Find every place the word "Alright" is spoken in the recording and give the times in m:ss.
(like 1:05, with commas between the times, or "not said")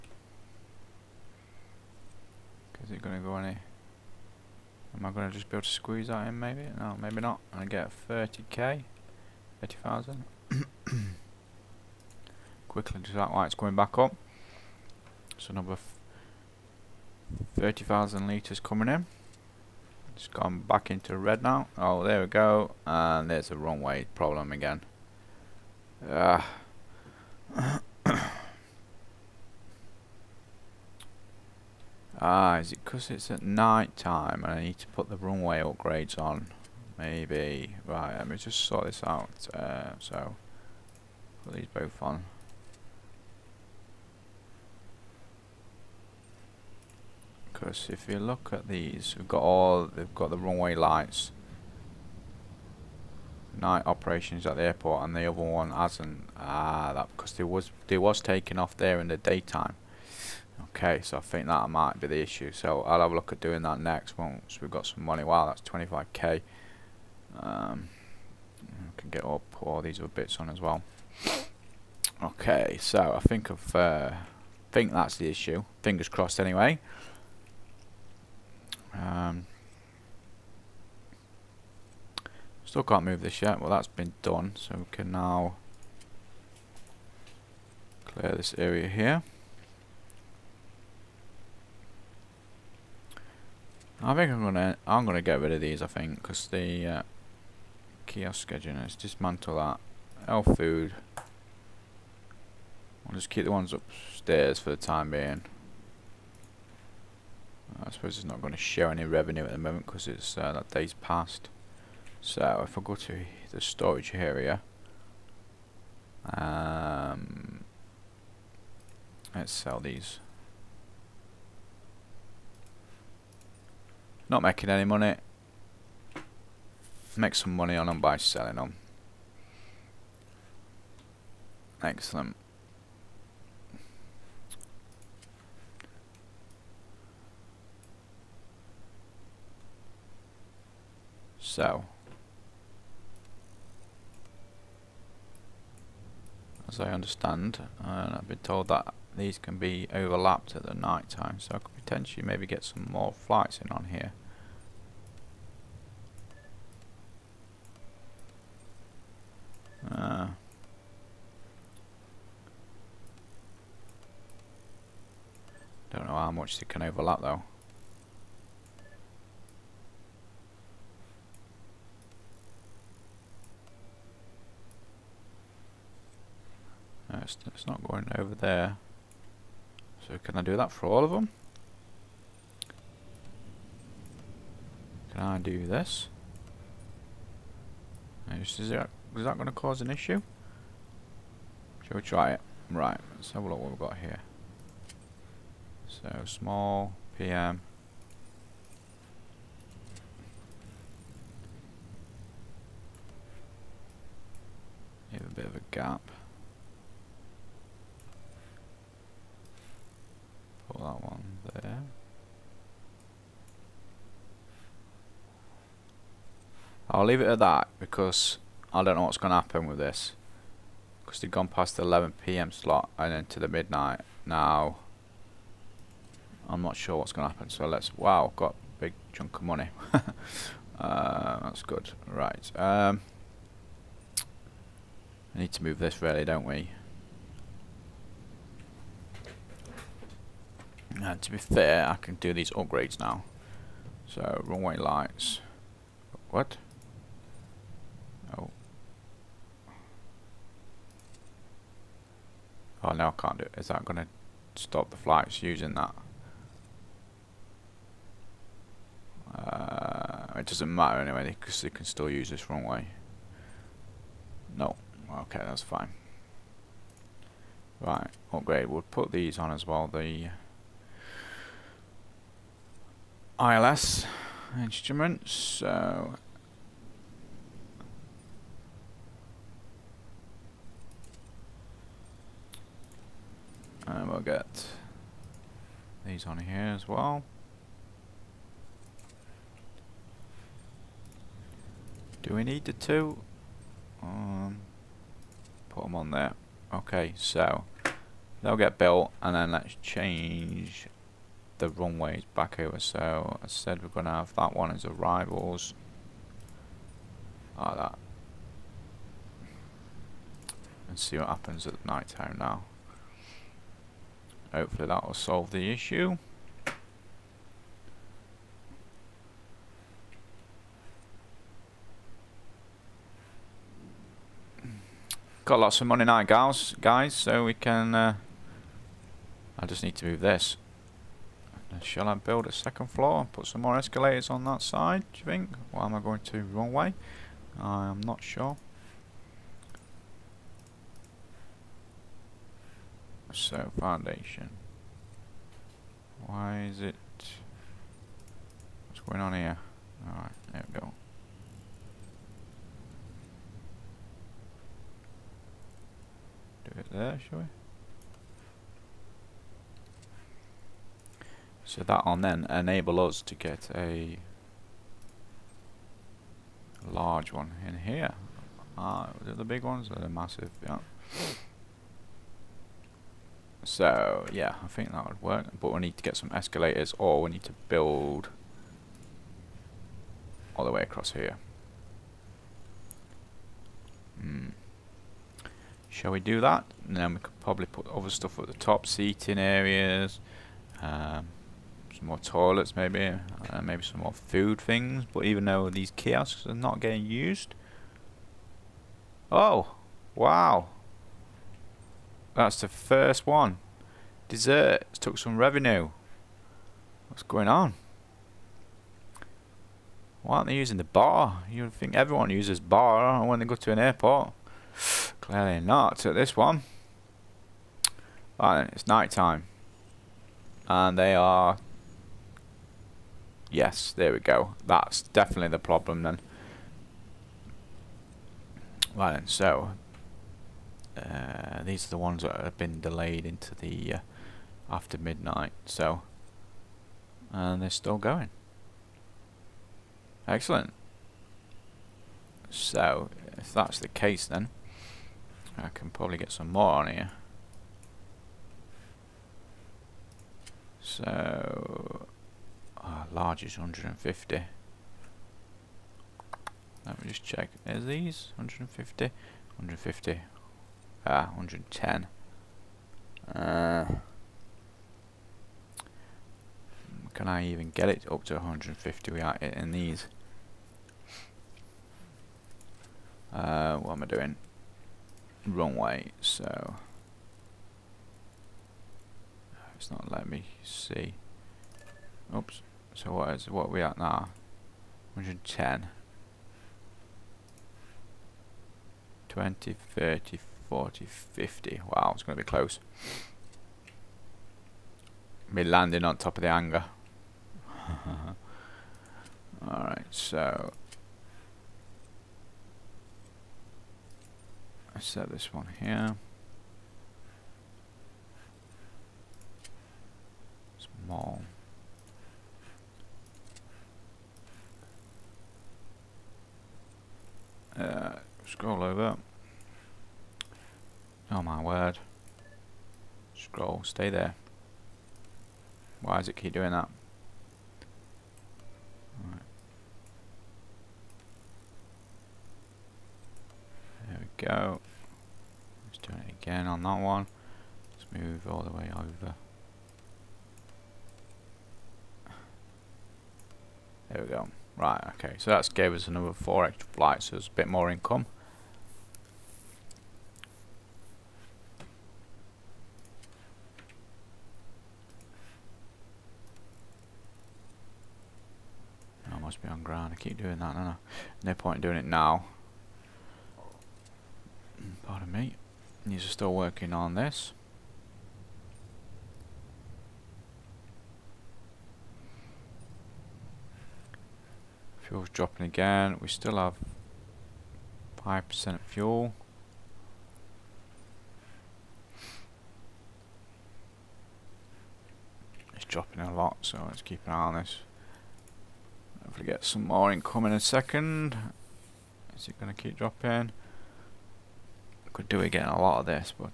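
5:50, 8:19.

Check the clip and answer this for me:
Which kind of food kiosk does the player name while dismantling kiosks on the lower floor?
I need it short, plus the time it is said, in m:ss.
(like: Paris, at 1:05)
Health food, at 1:40.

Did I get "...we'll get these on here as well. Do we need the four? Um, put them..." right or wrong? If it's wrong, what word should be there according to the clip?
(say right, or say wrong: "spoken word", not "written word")
wrong: "two", not "four".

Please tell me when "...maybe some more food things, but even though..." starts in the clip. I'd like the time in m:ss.
6:33.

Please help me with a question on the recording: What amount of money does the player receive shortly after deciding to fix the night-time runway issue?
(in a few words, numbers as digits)
25k.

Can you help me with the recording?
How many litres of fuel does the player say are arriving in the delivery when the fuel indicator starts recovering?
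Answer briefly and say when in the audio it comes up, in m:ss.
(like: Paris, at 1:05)
30,000, at 0:15.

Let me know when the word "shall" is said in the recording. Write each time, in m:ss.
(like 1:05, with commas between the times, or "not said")
3:11, 5:31, 5:57, 6:25.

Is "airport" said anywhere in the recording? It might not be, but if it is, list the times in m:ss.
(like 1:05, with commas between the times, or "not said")
0:54, 6:53.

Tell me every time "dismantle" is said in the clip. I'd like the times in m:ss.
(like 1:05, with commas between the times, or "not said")
1:38.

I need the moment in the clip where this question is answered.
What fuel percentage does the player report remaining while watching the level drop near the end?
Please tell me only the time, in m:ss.
9:38.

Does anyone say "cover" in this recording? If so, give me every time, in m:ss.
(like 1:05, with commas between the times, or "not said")
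not said.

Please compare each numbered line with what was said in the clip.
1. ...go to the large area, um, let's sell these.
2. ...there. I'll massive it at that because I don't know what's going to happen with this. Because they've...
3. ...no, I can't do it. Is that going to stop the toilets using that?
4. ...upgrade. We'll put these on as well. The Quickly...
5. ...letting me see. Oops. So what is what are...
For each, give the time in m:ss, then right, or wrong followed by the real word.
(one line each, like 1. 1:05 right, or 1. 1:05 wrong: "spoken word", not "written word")
1. 1:52 wrong: "storage", not "large"
2. 3:31 wrong: "leave", not "massive"
3. 4:12 wrong: "flights", not "toilets"
4. 4:28 wrong: "ILS", not "Quickly"
5. 8:00 right.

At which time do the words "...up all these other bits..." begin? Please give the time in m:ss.
1:09.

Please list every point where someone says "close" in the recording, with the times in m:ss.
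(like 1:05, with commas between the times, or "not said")
8:12.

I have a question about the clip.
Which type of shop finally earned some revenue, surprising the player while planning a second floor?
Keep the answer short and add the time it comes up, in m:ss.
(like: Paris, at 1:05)
Desserts, at 6:44.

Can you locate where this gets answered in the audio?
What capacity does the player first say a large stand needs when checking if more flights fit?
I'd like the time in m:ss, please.
7:33.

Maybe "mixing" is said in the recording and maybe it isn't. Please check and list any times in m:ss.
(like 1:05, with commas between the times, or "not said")
not said.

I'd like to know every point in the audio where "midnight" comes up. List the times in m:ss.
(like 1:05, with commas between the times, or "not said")
3:43, 7:14.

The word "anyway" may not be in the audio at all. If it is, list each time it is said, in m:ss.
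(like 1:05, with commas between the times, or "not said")
1:16, 4:20.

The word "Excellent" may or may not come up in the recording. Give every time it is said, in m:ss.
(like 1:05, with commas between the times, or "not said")
2:11, 7:20.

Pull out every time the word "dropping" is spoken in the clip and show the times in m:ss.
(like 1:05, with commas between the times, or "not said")
9:35, 9:45, 9:52.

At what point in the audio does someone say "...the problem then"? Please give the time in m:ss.
7:05.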